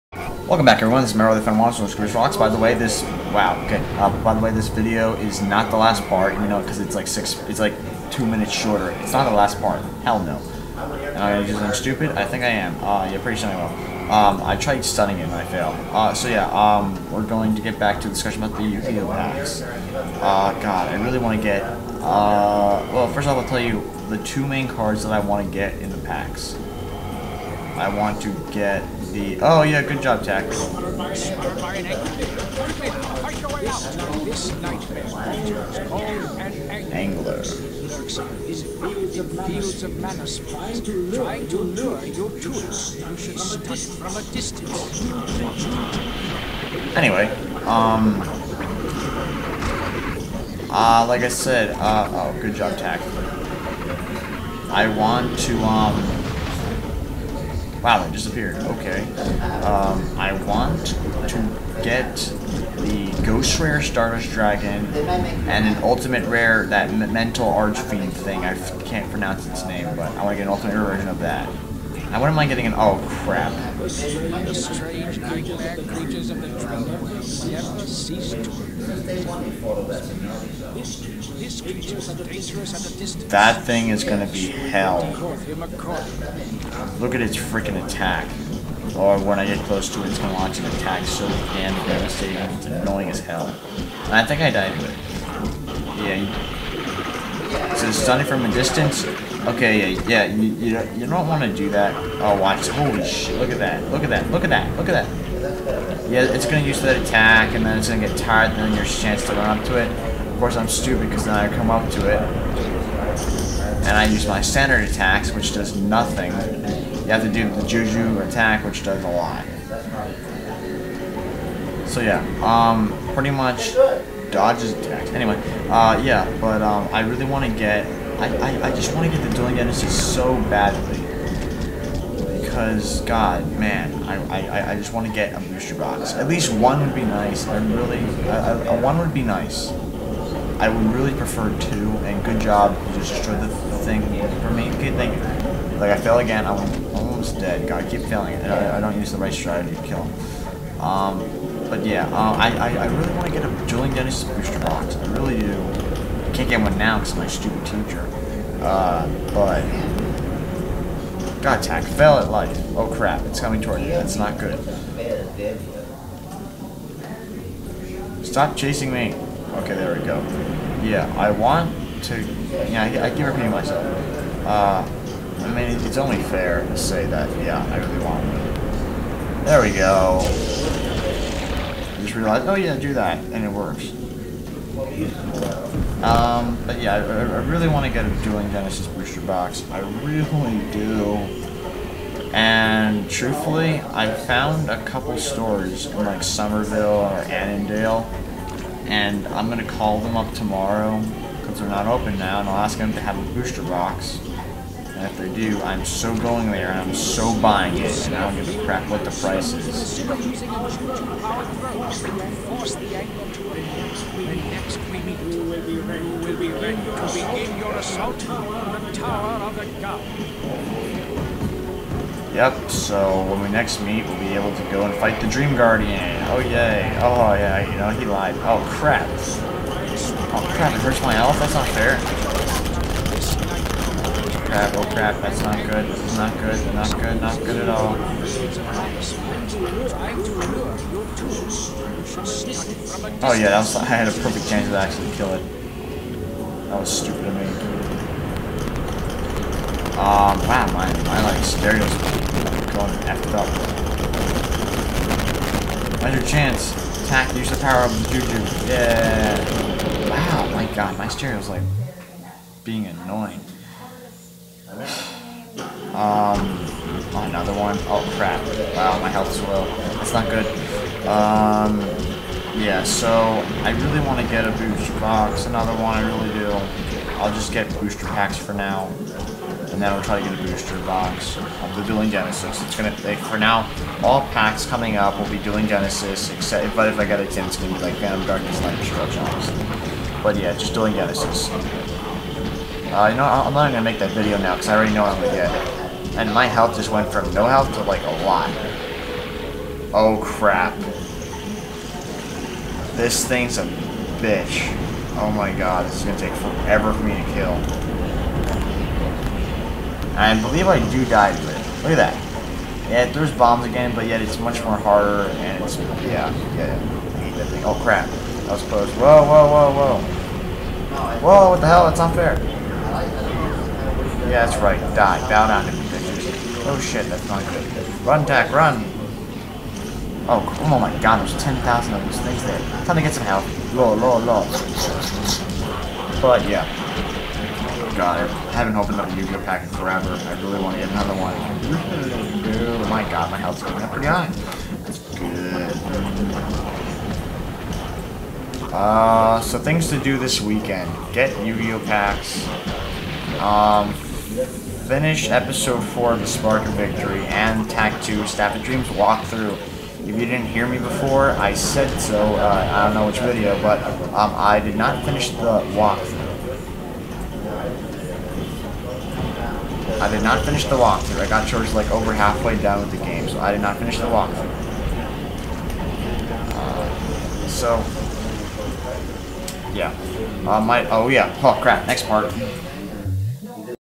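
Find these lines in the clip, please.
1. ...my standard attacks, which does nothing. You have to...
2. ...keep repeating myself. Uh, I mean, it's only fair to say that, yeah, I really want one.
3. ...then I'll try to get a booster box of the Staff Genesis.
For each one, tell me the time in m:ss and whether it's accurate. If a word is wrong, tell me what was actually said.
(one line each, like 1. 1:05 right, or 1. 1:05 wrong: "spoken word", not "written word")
1. 1:54 right
2. 2:53 right
3. 4:39 wrong: "Duelist", not "Staff".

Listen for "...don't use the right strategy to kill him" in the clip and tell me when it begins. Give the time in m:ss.
2:28.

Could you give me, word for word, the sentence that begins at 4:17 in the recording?
Attack, use the power of Juju.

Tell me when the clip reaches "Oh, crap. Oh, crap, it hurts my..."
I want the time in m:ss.
3:48.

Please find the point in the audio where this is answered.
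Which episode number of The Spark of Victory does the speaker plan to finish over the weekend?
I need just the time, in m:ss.
5:55.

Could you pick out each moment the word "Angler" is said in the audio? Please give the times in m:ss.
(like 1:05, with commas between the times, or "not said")
0:36.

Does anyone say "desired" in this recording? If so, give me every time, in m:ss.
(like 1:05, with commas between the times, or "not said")
not said.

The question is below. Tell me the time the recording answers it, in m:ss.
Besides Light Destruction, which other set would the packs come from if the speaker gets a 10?
4:47.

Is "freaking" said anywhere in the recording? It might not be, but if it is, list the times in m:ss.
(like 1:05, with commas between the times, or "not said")
1:27.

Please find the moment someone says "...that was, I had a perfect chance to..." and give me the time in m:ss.
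4:03.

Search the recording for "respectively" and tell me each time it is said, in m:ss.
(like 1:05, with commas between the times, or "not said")
not said.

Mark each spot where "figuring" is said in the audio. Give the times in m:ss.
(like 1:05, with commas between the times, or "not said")
not said.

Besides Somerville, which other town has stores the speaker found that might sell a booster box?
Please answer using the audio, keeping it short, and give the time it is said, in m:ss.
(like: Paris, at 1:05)
Annandale, at 3:17.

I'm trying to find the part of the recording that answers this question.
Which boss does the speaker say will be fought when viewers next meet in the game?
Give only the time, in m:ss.
3:45.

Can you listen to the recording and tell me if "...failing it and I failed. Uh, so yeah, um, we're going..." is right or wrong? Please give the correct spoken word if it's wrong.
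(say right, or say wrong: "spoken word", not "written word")
wrong: "studying", not "failing".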